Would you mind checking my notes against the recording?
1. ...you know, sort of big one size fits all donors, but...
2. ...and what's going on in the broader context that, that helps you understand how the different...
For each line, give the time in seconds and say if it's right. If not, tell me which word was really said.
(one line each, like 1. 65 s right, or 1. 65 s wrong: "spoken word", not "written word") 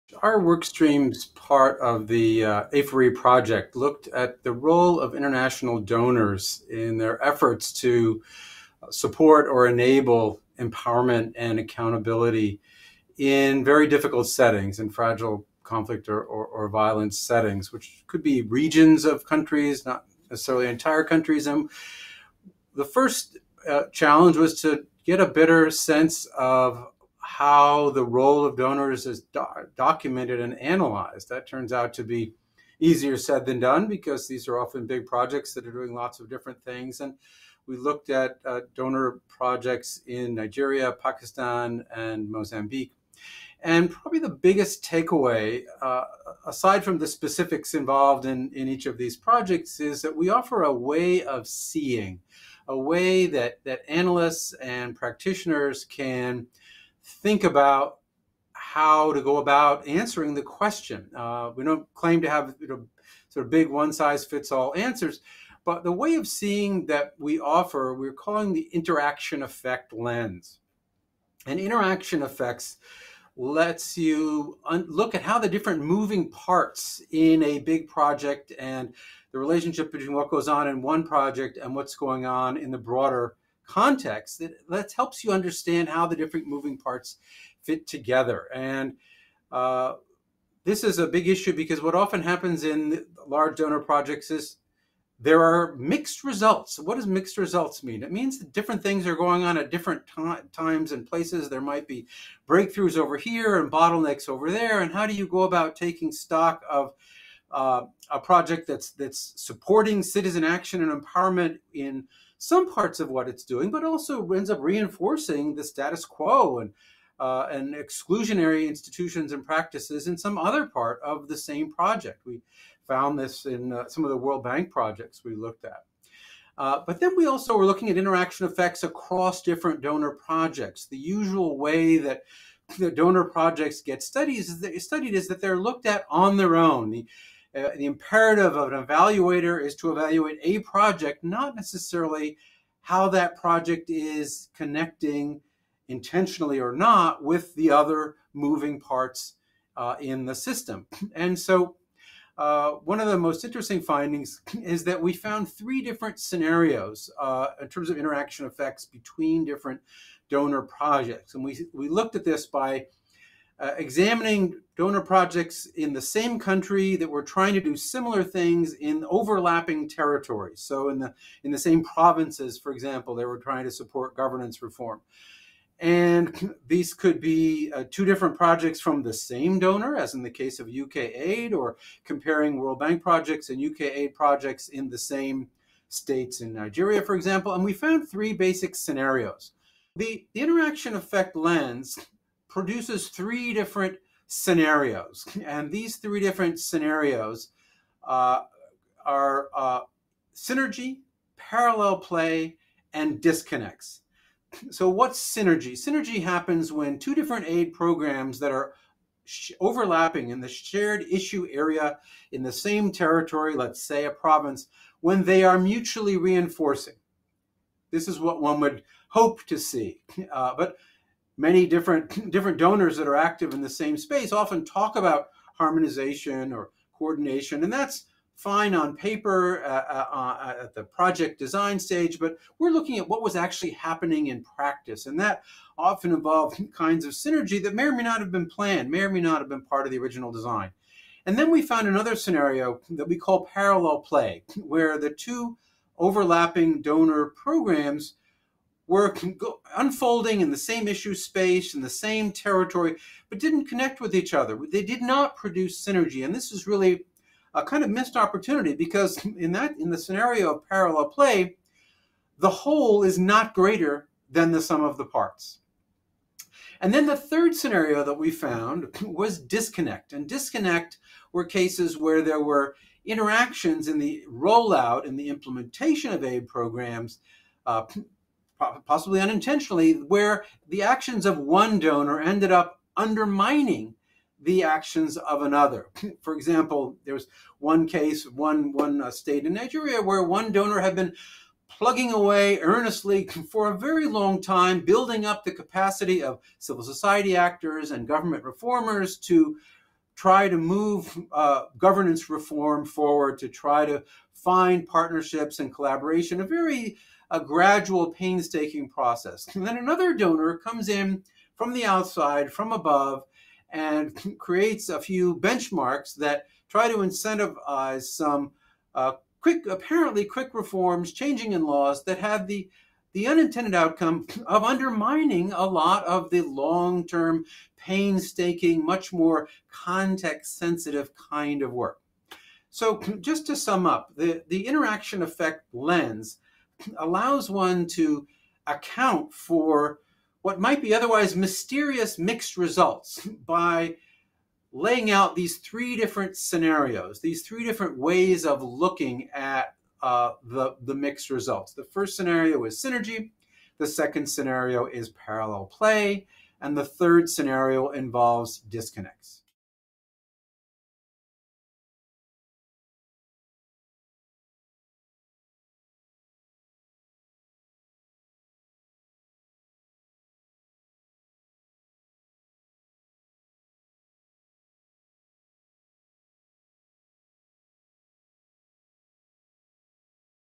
1. 62 s wrong: "answers", not "donors"
2. 81 s right.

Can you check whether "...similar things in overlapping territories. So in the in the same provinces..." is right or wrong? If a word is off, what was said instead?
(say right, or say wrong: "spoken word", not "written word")
right.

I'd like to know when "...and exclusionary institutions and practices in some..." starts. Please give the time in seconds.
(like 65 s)
117 s.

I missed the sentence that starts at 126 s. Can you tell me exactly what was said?
Uh, but then we also were looking at interaction effects across different donor projects.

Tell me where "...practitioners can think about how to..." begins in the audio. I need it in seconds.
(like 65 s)
54 s.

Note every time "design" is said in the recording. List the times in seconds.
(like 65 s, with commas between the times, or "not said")
231 s, 240 s.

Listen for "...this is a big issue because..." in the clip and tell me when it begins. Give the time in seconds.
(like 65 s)
90 s.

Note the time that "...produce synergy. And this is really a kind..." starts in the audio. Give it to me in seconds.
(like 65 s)
255 s.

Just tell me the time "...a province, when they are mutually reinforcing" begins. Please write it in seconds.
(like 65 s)
214 s.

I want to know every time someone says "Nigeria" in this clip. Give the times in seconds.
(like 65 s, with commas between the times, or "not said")
40 s, 186 s, 289 s.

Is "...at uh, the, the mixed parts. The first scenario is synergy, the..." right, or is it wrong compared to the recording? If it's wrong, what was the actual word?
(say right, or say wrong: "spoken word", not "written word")
wrong: "results", not "parts".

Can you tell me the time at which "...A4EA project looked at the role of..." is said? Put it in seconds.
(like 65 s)
2 s.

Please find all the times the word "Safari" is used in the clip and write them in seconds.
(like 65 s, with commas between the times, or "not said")
not said.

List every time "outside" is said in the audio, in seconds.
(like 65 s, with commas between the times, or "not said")
311 s.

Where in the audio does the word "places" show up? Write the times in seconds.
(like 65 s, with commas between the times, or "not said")
101 s.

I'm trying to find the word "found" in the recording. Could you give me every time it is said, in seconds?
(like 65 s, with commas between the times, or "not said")
122 s, 155 s, 187 s, 241 s, 268 s.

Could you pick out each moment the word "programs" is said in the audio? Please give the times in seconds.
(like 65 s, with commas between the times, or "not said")
207 s, 247 s, 276 s.